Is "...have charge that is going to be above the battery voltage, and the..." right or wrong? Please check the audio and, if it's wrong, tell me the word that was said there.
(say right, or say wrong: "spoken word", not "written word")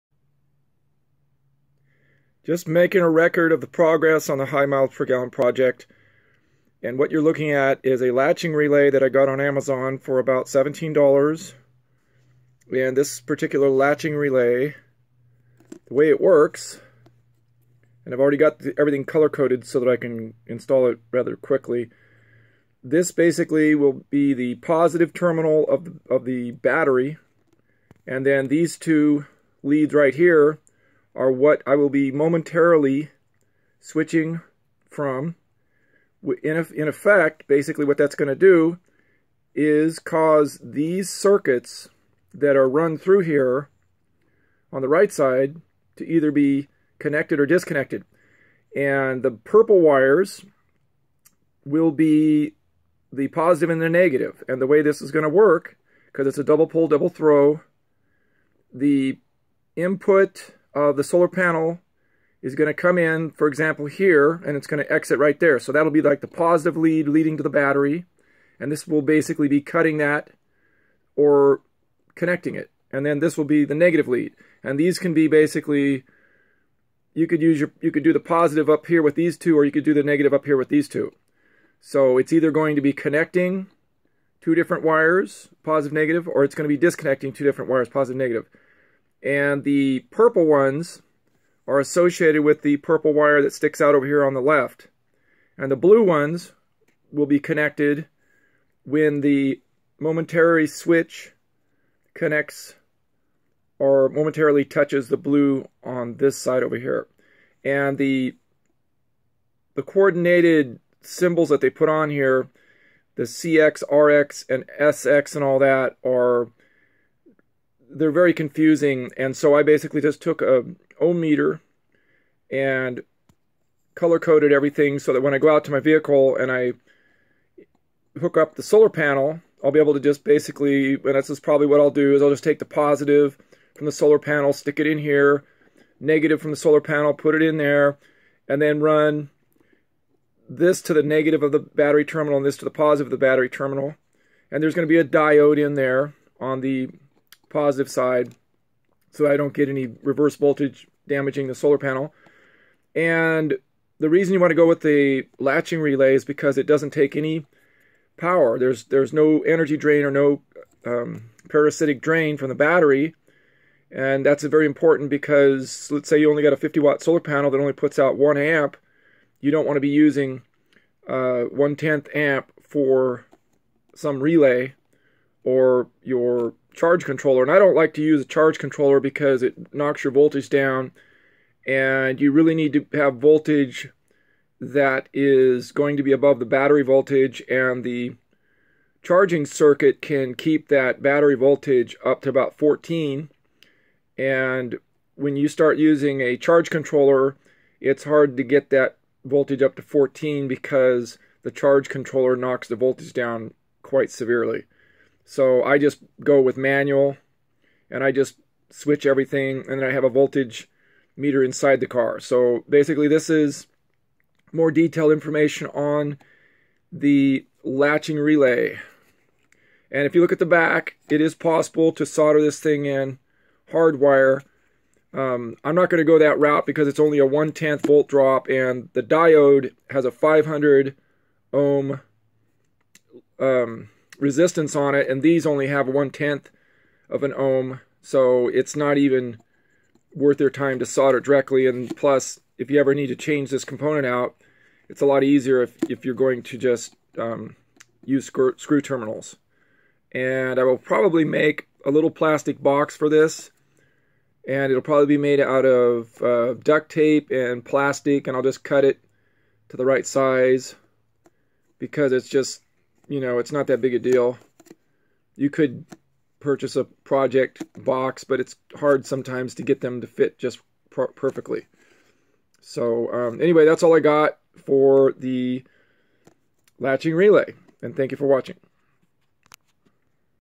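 wrong: "voltage", not "charge".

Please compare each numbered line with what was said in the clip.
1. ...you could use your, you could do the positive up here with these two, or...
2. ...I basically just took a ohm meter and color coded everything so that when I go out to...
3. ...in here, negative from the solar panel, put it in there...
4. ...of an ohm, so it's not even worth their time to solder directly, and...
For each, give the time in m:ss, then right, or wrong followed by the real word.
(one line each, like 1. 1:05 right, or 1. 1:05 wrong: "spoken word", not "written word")
1. 1:17 right
2. 1:59 right
3. 2:14 right
4. 3:57 right.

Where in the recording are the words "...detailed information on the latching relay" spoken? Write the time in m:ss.
3:34.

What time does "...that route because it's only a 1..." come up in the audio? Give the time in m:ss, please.
3:46.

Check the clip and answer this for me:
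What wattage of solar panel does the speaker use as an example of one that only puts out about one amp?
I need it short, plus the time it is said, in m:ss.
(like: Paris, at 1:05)
50 watt, at 2:46.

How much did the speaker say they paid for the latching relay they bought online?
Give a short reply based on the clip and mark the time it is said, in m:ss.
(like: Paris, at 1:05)
$17, at 0:10.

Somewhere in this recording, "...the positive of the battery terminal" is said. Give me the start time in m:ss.
2:22.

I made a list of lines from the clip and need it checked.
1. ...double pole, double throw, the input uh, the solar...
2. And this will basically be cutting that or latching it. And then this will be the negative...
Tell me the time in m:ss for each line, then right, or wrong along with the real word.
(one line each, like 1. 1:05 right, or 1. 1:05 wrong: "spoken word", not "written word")
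1. 0:56 right
2. 1:08 wrong: "connecting", not "latching".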